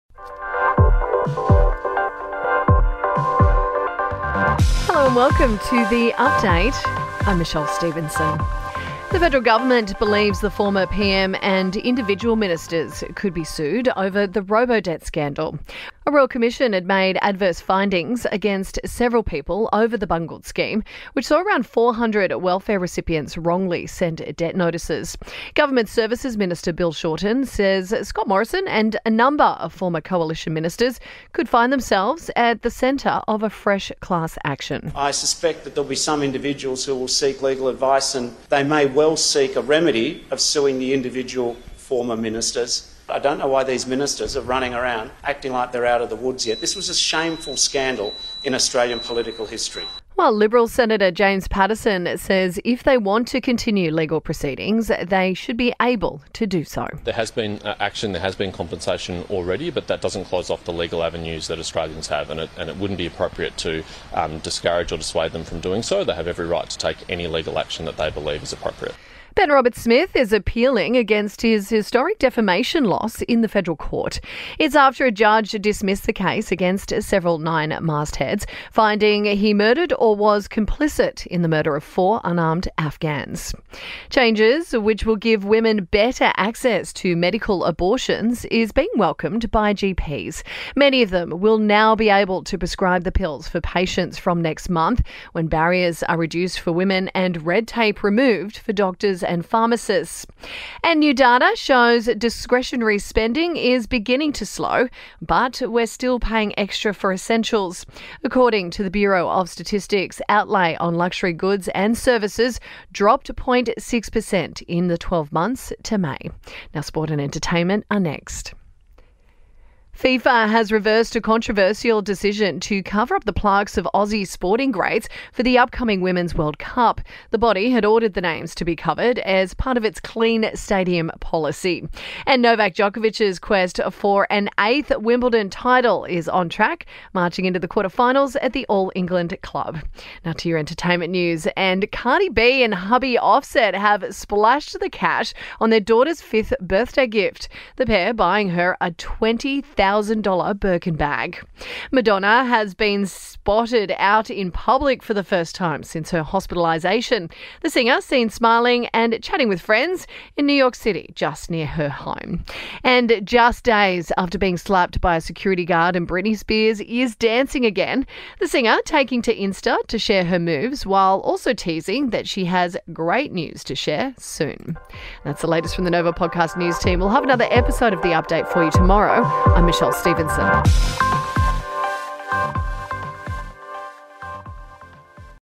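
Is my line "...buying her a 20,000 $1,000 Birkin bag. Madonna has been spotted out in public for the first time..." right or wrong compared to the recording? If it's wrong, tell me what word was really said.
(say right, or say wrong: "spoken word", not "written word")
right.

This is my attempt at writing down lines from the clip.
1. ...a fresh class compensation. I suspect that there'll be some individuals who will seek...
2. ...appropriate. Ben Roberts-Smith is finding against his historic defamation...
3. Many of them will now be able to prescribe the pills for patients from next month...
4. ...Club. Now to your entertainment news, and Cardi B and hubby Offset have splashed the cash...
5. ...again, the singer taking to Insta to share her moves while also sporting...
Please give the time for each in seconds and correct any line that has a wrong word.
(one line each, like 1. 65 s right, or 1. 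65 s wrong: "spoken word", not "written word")
1. 33 s wrong: "action", not "compensation"
2. 68 s wrong: "appealing", not "finding"
3. 90 s right
4. 139 s right
5. 167 s wrong: "teasing", not "sporting".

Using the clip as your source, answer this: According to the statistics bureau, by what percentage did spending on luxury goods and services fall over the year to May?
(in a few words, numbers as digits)
0.6%.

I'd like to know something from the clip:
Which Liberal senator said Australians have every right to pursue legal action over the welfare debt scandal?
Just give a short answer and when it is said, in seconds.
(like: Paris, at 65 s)
James Paterson, at 51 s.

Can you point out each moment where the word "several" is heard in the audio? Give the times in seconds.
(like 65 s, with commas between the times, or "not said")
18 s, 77 s.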